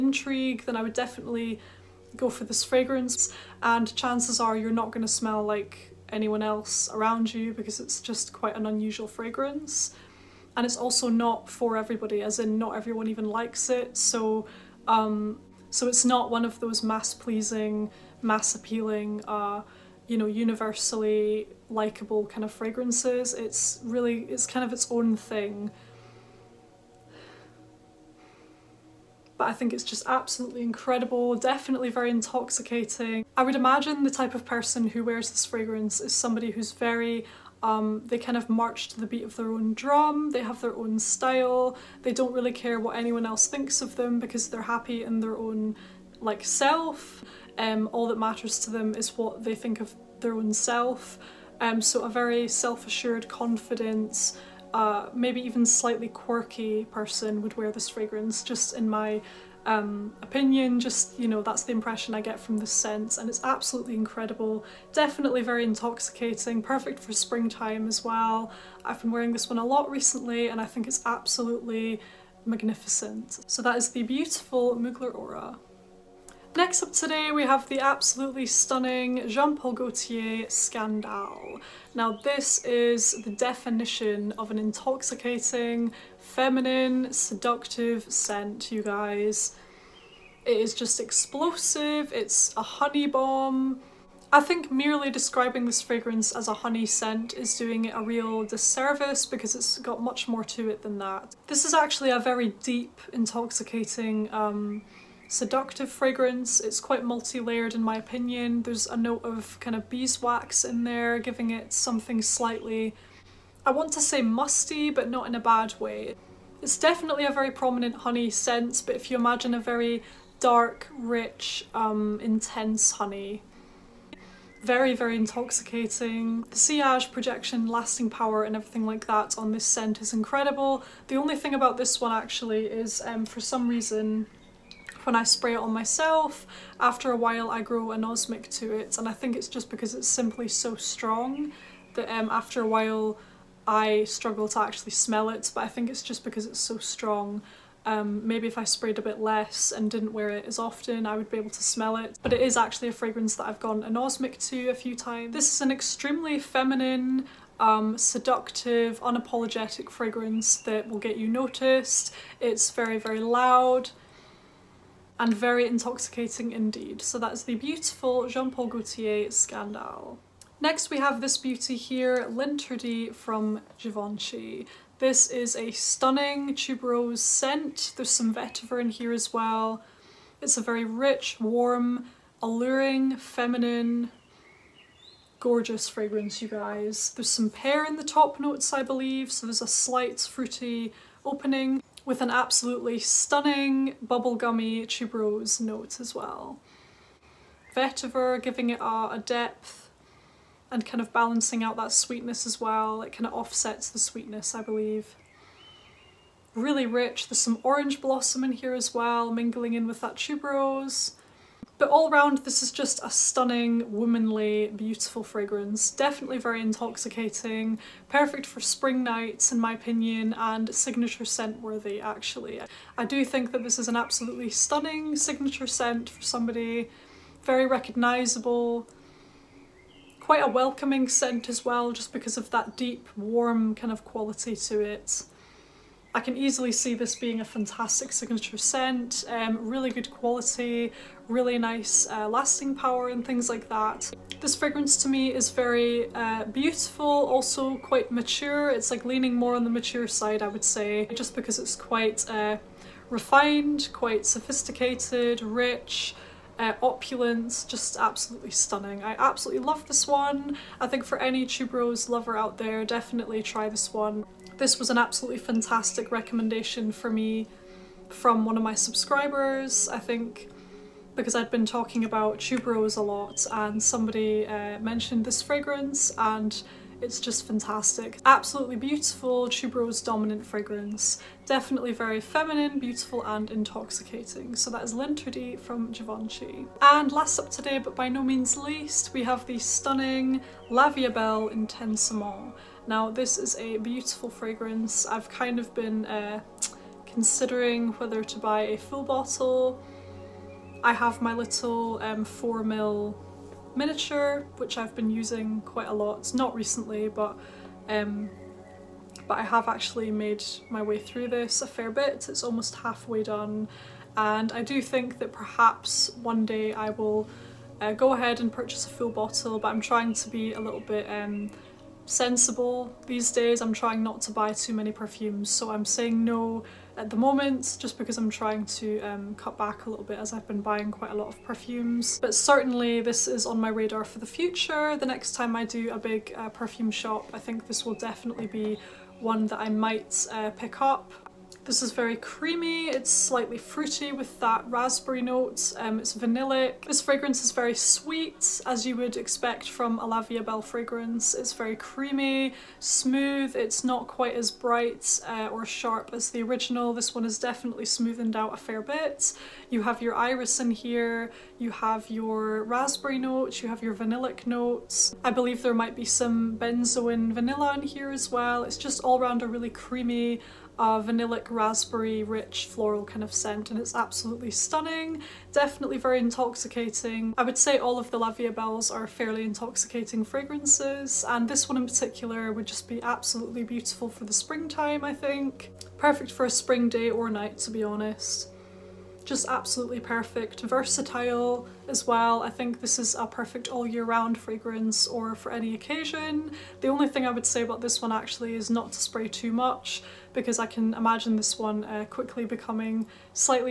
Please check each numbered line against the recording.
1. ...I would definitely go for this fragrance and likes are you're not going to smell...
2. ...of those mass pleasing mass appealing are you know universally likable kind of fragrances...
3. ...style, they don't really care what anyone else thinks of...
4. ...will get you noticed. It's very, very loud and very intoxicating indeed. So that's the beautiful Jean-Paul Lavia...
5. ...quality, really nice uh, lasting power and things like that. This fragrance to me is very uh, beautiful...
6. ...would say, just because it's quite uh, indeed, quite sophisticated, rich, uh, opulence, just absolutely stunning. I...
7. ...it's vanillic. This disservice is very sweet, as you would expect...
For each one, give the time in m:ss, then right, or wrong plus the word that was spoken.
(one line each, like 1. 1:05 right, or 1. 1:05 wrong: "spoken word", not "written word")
1. 0:00 wrong: "chances", not "likes"
2. 0:16 right
3. 0:40 right
4. 2:40 wrong: "Gaultier", not "Lavia"
5. 4:00 right
6. 4:10 wrong: "refined", not "indeed"
7. 5:45 wrong: "fragrance", not "disservice".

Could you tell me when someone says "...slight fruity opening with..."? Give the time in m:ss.
3:09.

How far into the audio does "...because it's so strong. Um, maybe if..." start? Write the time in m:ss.
2:26.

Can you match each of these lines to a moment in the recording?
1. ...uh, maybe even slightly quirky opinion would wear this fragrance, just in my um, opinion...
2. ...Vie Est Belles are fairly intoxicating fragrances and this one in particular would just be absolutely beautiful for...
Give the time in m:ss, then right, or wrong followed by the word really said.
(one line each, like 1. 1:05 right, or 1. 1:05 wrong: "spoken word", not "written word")
1. 0:54 wrong: "person", not "opinion"
2. 6:18 right.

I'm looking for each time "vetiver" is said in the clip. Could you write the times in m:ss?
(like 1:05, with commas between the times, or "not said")
2:58, 3:17.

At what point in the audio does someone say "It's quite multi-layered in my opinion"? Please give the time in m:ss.
1:46.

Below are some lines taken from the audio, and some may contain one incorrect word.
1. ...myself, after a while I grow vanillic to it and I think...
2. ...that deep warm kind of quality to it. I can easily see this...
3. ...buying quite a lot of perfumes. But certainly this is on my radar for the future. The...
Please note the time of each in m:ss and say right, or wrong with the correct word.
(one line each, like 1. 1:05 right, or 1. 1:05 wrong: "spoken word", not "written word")
1. 2:15 wrong: "anosmic", not "vanillic"
2. 3:52 right
3. 5:30 right.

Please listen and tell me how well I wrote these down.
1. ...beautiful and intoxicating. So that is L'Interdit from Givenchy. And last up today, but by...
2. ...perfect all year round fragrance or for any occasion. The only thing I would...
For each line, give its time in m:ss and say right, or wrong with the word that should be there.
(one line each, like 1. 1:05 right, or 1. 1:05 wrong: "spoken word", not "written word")
1. 4:42 right
2. 6:33 right.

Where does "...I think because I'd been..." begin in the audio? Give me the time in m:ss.
4:29.